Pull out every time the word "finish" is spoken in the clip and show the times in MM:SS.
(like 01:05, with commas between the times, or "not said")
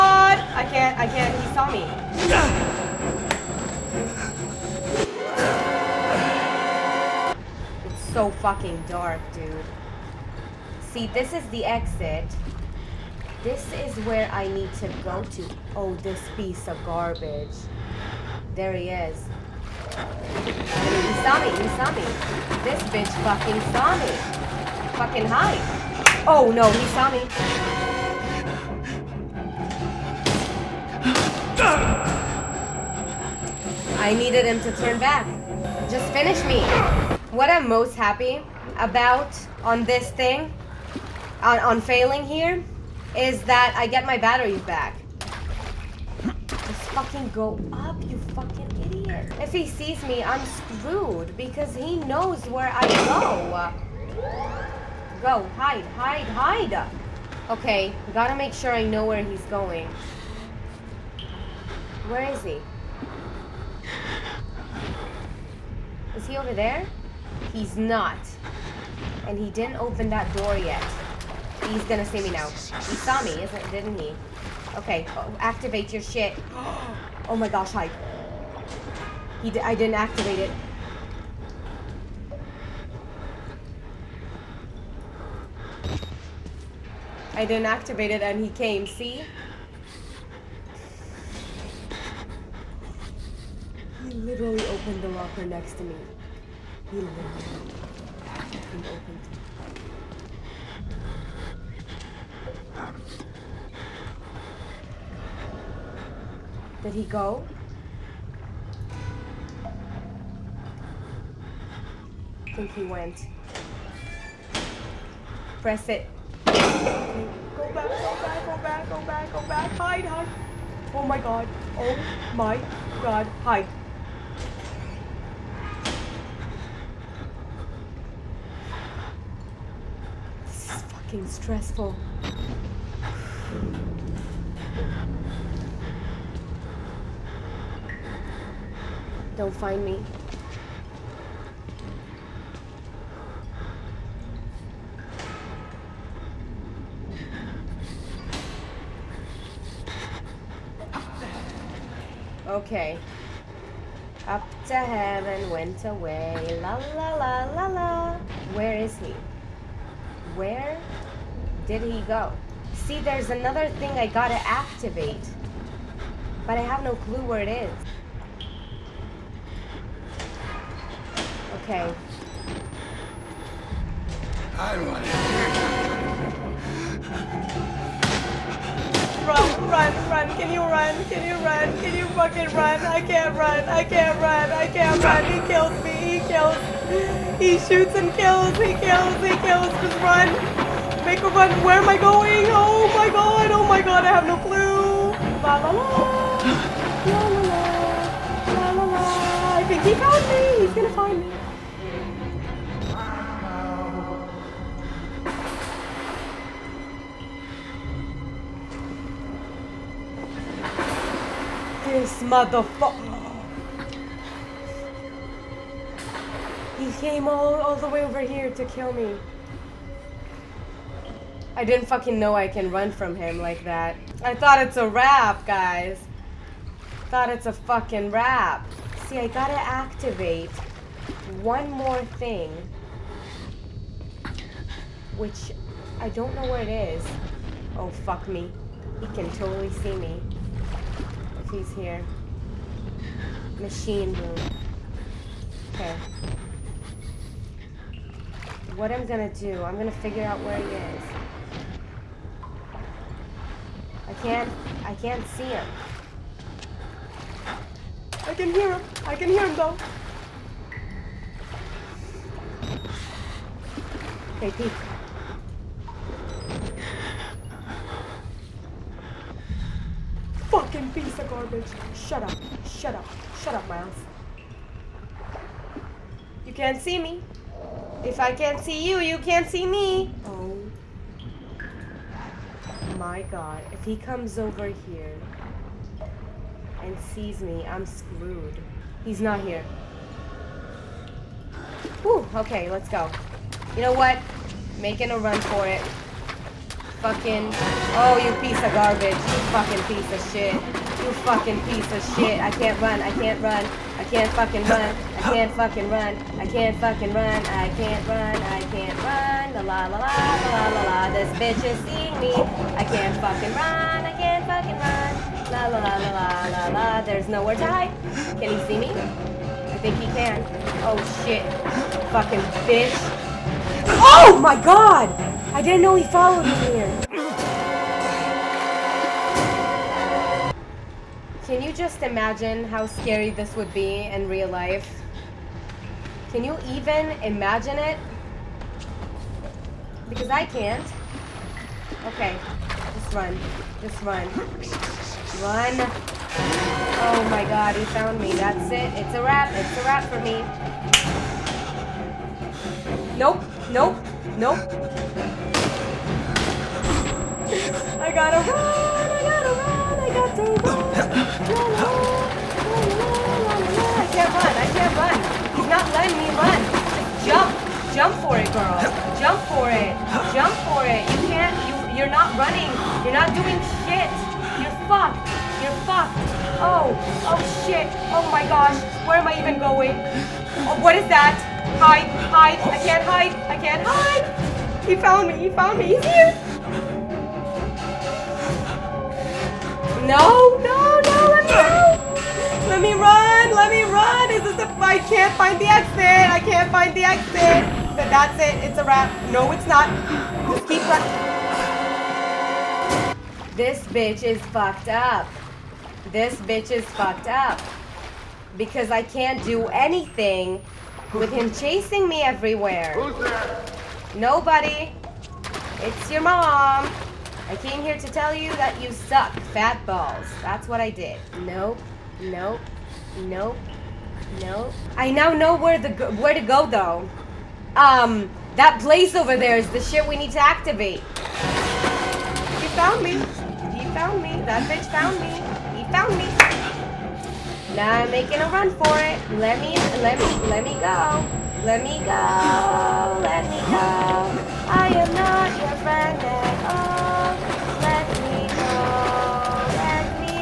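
00:36.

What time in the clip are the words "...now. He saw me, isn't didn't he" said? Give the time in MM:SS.
01:12.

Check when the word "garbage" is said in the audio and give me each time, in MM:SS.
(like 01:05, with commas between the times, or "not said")
00:16, 04:31, 04:58.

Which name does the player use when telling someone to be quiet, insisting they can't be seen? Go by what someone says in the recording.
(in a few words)
Miles.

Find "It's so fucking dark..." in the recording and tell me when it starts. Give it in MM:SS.
00:07.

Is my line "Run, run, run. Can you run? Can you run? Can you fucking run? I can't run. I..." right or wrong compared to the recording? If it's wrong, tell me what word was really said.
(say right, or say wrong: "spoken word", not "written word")
right.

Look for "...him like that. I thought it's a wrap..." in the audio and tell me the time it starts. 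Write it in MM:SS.
03:43.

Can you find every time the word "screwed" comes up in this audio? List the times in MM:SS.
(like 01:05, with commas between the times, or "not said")
00:50, 04:47.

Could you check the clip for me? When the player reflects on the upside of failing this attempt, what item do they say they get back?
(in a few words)
batteries.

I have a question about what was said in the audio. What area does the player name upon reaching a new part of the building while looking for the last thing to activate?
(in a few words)
Machine room.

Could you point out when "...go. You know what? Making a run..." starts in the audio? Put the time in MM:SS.
04:52.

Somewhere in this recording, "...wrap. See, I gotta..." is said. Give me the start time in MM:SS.
03:48.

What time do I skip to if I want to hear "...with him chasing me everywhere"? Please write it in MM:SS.
06:51.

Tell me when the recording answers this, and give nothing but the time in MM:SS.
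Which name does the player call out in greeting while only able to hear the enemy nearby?
04:24.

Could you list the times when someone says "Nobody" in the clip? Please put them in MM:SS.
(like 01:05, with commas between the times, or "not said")
06:54.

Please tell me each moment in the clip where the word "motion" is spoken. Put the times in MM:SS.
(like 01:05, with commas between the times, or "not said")
not said.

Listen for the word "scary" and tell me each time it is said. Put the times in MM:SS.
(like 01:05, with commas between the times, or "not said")
05:32.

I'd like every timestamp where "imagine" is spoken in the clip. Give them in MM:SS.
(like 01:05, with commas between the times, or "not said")
05:32, 05:37.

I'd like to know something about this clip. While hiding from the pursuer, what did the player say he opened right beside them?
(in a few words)
the locker.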